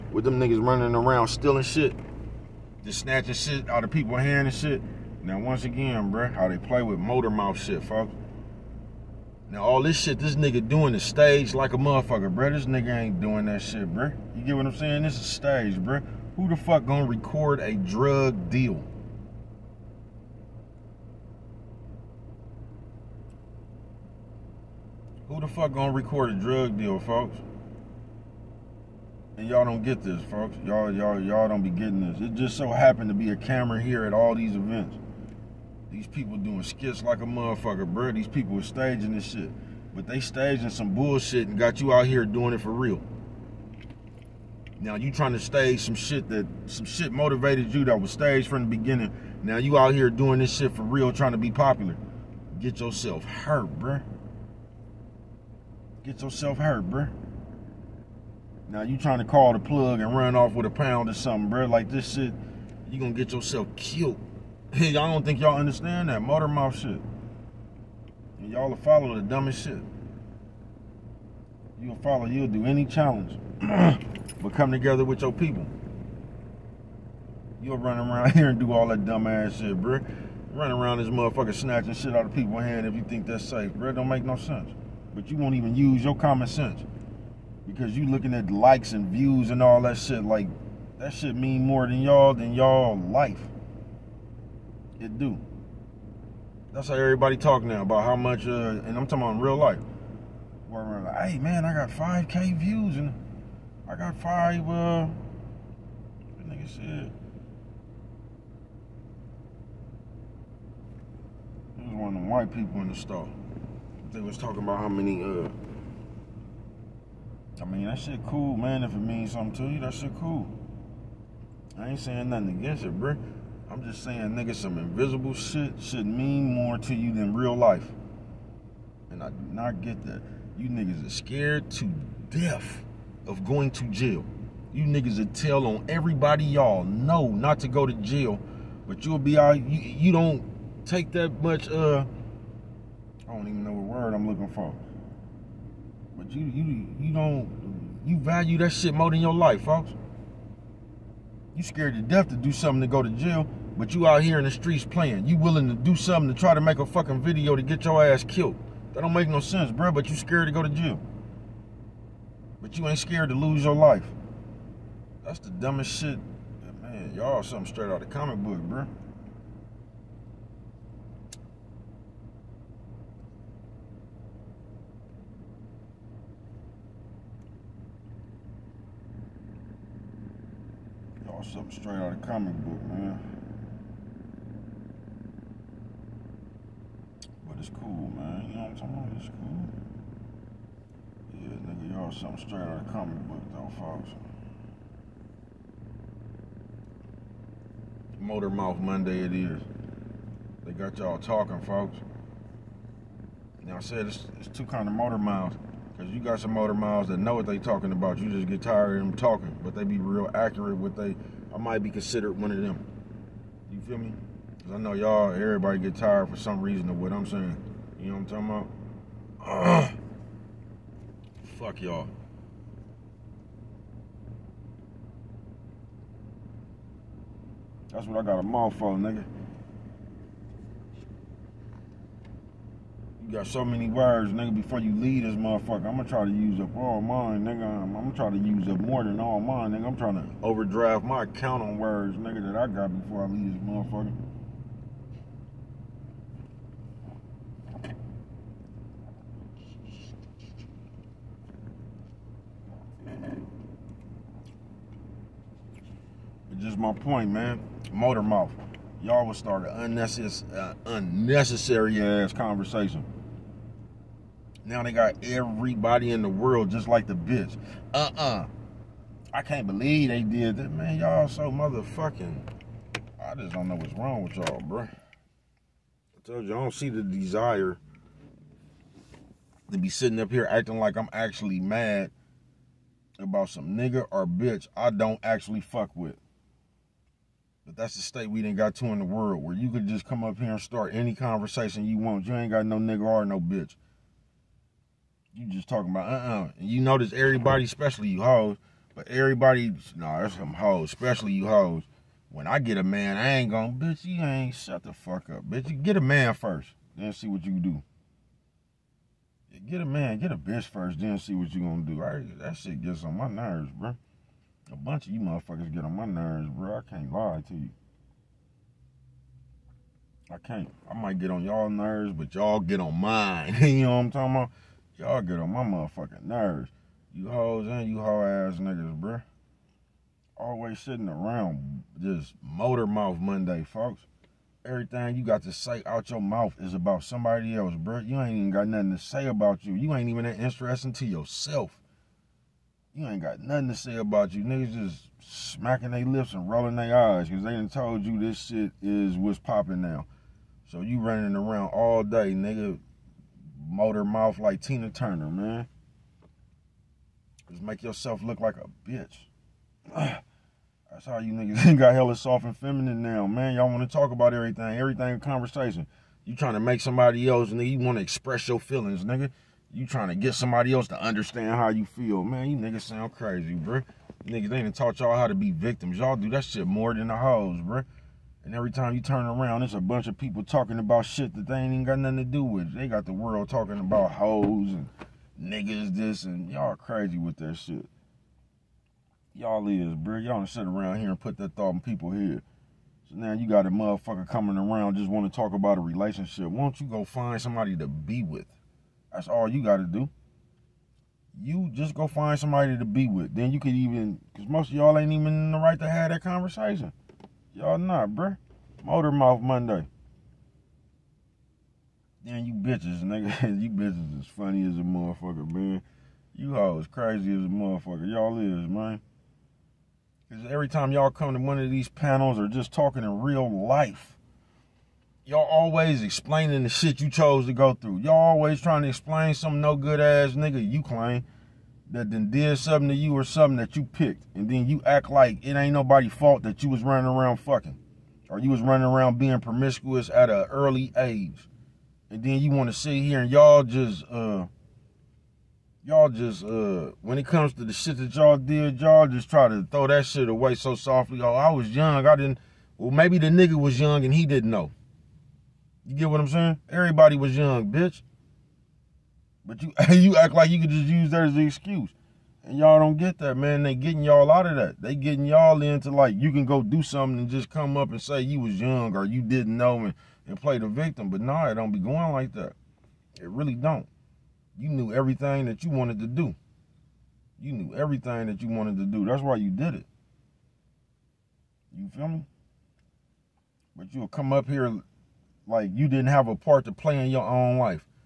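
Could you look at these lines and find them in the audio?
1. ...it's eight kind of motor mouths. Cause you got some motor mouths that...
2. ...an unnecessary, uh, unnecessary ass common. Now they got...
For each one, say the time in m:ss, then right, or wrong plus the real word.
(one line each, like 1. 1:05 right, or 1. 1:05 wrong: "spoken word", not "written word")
1. 3:24 wrong: "two", not "eight"
2. 4:19 wrong: "conversation", not "common".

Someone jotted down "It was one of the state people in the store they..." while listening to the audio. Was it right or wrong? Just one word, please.
wrong.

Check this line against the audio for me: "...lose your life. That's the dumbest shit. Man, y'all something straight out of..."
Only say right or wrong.
right.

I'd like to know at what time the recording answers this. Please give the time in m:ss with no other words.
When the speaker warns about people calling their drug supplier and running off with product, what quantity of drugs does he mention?
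1:00.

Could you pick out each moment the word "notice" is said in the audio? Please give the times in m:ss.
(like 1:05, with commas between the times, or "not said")
4:56.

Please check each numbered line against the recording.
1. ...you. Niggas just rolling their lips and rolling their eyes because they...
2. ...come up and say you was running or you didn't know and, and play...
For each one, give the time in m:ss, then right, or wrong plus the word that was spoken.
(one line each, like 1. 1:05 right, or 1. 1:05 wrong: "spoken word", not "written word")
1. 5:44 wrong: "smacking", not "rolling"
2. 7:47 wrong: "young", not "running".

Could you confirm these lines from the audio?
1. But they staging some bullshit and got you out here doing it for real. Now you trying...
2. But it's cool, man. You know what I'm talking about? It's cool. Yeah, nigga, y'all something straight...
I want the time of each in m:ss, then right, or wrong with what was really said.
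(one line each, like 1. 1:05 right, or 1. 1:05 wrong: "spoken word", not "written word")
1. 0:39 right
2. 3:07 right.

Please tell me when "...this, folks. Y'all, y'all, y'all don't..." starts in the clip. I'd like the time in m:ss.
0:30.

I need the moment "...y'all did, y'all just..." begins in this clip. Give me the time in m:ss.
7:28.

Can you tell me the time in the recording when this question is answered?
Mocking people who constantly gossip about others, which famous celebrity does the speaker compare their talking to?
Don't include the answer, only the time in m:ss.
5:54.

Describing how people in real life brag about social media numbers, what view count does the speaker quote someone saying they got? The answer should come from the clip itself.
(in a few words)
5K views.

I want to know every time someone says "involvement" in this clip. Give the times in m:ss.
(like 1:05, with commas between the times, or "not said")
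not said.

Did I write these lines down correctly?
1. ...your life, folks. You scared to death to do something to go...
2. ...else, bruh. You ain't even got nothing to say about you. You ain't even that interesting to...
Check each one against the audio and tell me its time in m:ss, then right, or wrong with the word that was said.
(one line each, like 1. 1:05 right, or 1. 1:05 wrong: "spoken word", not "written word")
1. 2:29 right
2. 5:37 right.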